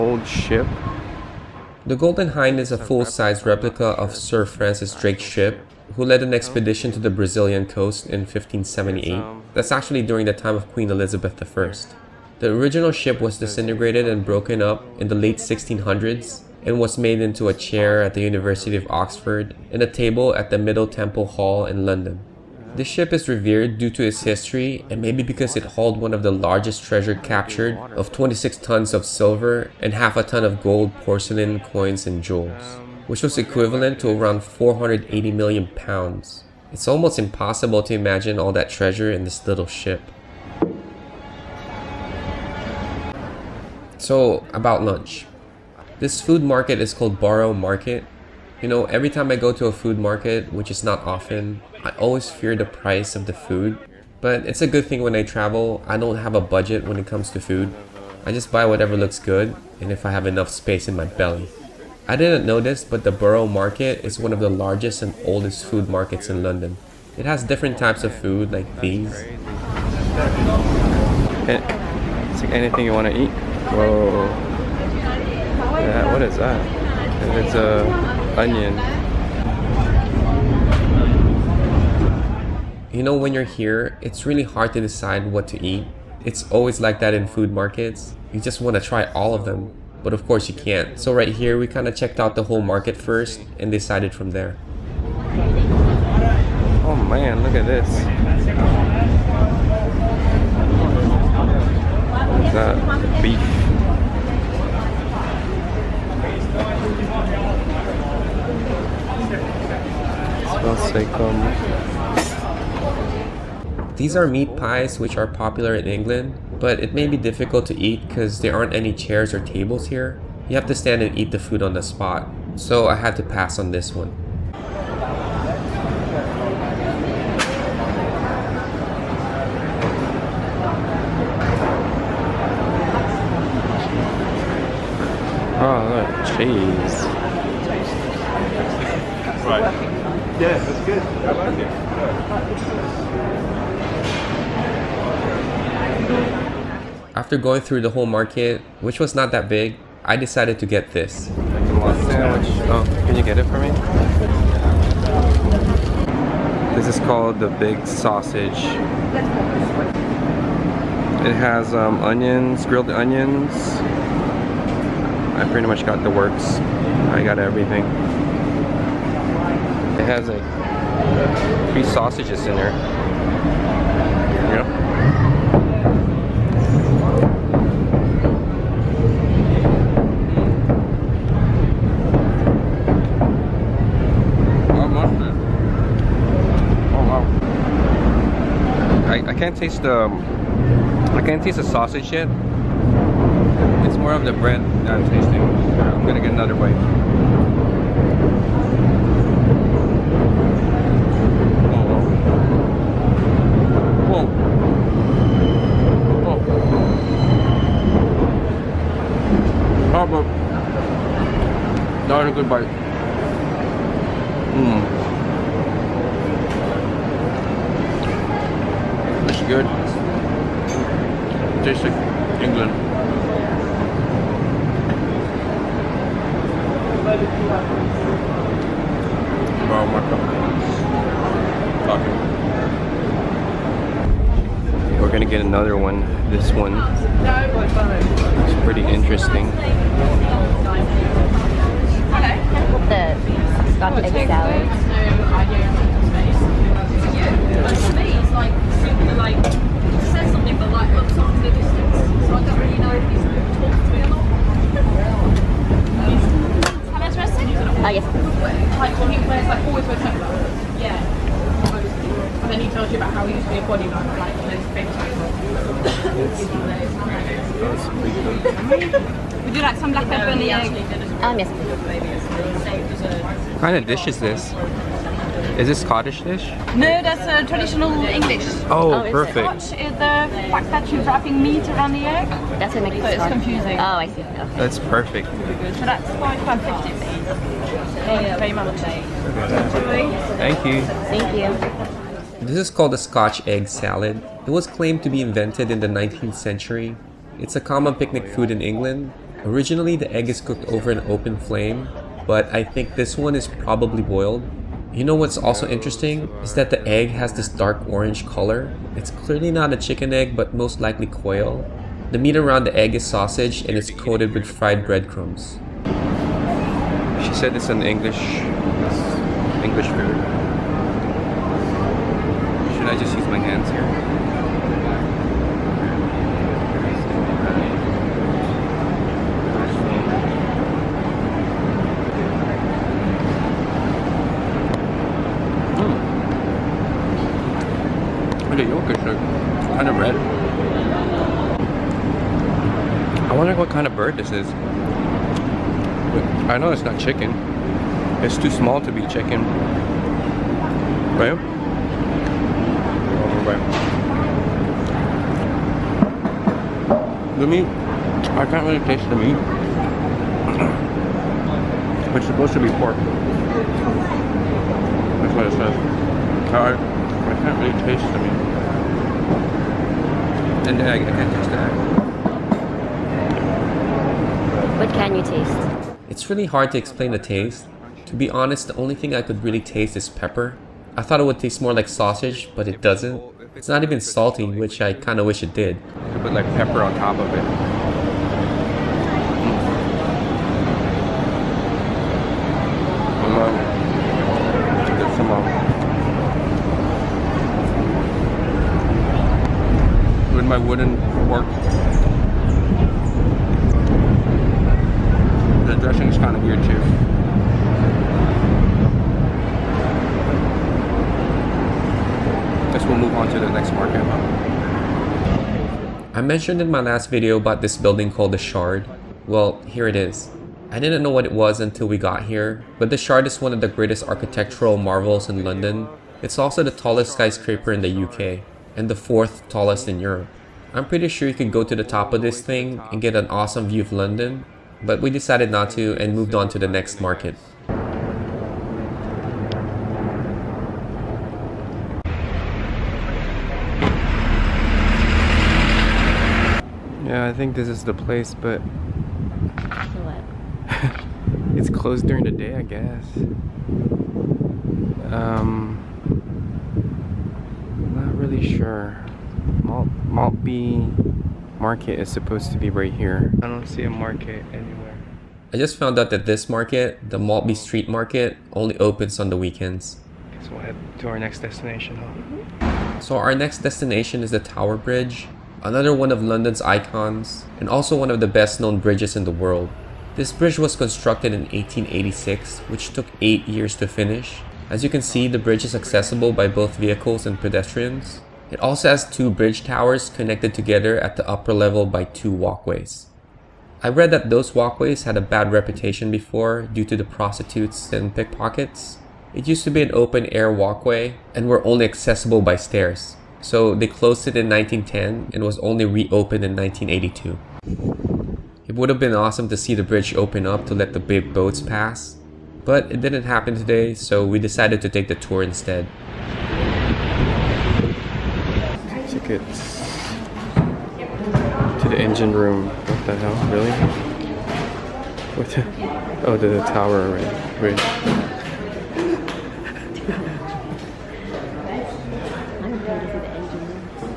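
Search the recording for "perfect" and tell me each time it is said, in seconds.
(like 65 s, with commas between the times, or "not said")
279 s, 284 s.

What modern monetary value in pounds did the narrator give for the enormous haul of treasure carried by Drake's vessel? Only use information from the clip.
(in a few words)
480 million pounds.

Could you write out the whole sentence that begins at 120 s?
You have to stand and eat the food on the spot, so I had to pass on this one.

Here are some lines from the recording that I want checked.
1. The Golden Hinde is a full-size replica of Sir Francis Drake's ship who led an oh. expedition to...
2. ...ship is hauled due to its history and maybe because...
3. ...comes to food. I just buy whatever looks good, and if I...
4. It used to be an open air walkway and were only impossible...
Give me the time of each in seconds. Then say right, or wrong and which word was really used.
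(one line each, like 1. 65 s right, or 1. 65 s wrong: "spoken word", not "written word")
1. 1 s right
2. 22 s wrong: "revered", not "hauled"
3. 57 s right
4. 499 s wrong: "accessible", not "impossible".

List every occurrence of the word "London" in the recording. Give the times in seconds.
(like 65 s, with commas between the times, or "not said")
21 s, 66 s, 425 s, 433 s, 476 s.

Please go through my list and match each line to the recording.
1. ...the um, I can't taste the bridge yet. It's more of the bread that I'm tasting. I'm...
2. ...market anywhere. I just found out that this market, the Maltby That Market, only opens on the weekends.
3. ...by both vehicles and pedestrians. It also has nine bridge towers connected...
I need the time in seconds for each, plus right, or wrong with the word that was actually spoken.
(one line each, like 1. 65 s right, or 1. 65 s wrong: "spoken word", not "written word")
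1. 189 s wrong: "sausage", not "bridge"
2. 463 s wrong: "Street", not "That"
3. 486 s wrong: "two", not "nine".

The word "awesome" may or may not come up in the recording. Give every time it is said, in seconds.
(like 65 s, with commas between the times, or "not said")
433 s, 509 s.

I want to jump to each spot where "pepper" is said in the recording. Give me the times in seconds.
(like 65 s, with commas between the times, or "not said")
270 s, 380 s, 386 s.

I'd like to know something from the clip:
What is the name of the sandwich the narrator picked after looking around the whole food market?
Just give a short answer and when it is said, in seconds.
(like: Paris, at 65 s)
Big Sausage, at 157 s.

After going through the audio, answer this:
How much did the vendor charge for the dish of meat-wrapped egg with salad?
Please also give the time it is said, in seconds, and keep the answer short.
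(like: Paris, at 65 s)
£5.50, at 286 s.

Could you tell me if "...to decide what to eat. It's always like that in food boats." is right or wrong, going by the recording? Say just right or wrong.
wrong.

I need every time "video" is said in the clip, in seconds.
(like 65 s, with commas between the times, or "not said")
417 s.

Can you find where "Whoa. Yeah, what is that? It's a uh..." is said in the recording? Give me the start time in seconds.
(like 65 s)
73 s.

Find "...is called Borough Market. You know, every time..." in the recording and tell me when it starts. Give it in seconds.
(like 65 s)
46 s.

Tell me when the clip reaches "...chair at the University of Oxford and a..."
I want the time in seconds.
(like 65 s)
17 s.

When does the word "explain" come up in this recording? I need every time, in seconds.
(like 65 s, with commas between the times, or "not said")
376 s.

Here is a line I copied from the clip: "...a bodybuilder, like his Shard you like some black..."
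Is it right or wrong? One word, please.
wrong.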